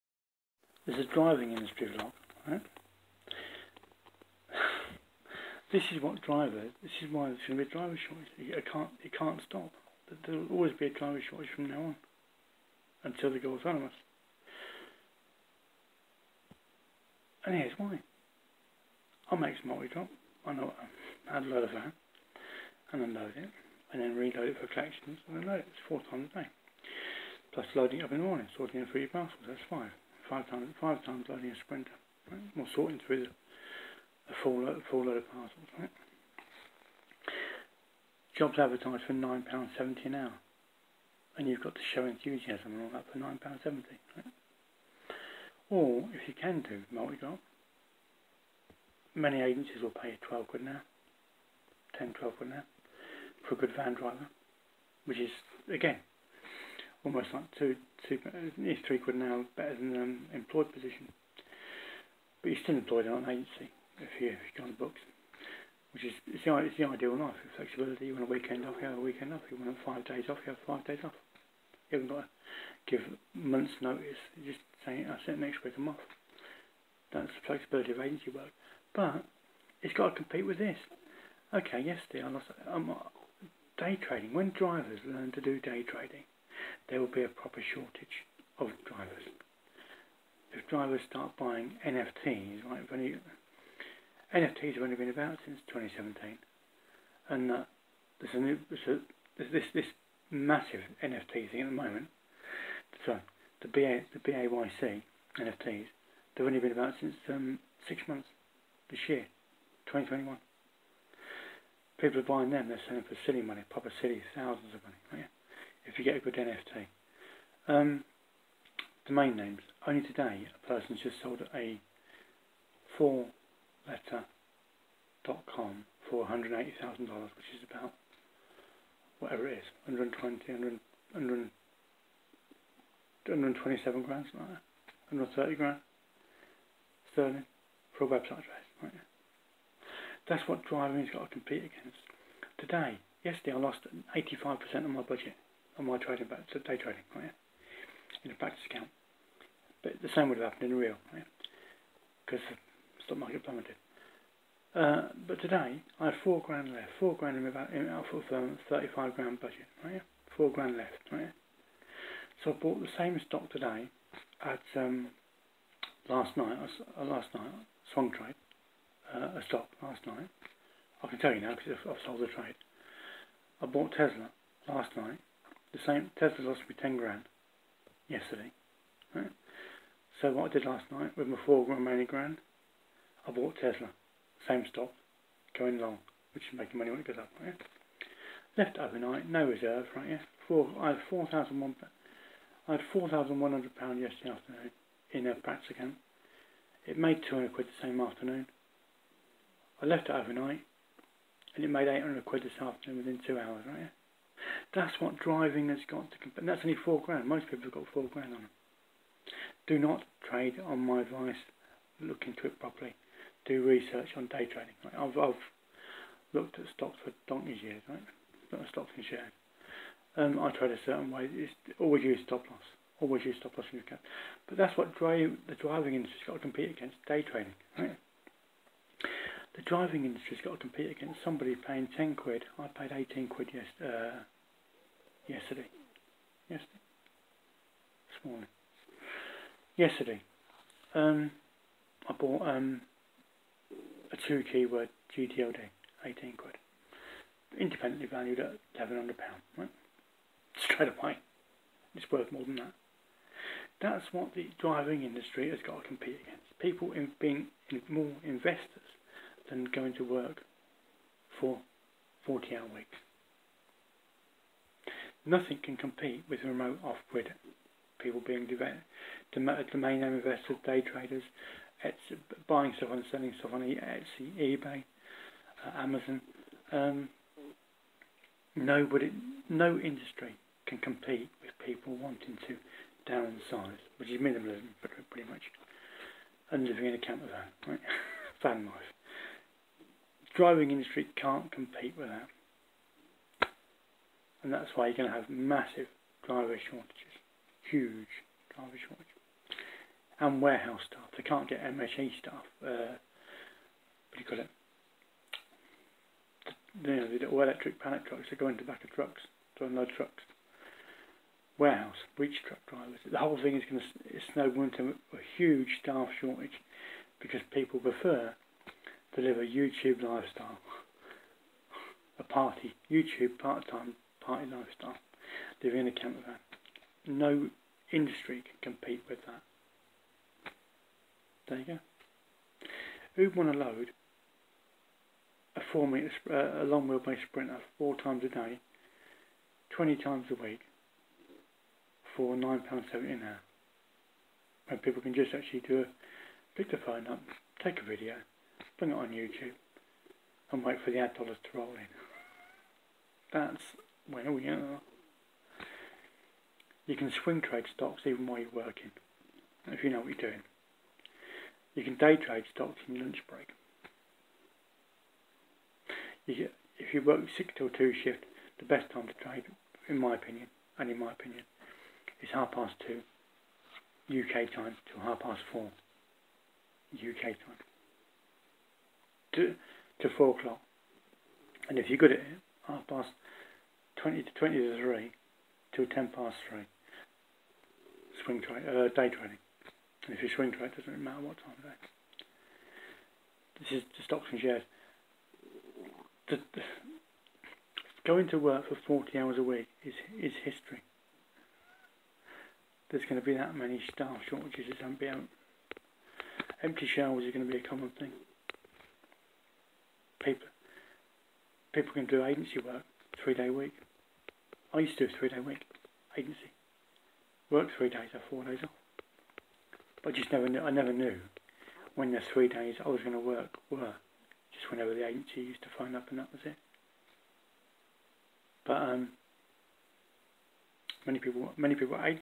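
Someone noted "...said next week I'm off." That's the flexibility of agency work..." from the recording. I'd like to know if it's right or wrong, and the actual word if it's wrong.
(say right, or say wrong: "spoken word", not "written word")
right.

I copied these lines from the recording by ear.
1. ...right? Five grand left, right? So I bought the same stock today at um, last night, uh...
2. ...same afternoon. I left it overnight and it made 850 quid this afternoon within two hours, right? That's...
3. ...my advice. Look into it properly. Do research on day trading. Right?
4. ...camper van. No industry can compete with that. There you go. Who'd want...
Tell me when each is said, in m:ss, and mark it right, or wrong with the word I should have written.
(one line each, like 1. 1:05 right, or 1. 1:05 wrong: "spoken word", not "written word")
1. 2:39 wrong: "Four", not "Five"
2. 3:17 wrong: "800", not "850"
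3. 3:30 right
4. 5:25 right.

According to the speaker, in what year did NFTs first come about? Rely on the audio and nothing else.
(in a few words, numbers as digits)
2017.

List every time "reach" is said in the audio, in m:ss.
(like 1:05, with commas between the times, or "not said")
5:12.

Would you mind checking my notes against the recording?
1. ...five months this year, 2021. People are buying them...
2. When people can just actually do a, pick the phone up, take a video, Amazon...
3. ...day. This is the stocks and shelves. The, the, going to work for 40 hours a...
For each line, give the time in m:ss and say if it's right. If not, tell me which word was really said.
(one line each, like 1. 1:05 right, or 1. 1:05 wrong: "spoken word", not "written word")
1. 1:47 wrong: "six", not "five"
2. 5:44 wrong: "Bring", not "Amazon"
3. 6:31 wrong: "shares", not "shelves".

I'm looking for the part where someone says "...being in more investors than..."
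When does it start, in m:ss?
4:17.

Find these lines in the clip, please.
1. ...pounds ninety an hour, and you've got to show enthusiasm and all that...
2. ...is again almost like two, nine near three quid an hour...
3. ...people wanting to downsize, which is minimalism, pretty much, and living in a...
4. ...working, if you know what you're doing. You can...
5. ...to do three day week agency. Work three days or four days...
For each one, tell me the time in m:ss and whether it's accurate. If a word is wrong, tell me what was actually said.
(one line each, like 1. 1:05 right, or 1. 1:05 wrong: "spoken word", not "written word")
1. 0:39 wrong: "seventy", not "ninety"
2. 0:55 wrong: "two", not "nine"
3. 4:41 right
4. 5:58 right
5. 6:54 right.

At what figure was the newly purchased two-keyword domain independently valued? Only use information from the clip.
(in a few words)
£1,100.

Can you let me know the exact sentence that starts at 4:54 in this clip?
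And that's why you're going to have massive driver shortages, huge driver shortages.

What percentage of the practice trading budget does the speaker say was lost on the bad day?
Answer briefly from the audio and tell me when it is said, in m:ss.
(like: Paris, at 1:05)
85%, at 2:24.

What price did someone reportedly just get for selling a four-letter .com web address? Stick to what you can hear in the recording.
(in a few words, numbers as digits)
$180,000.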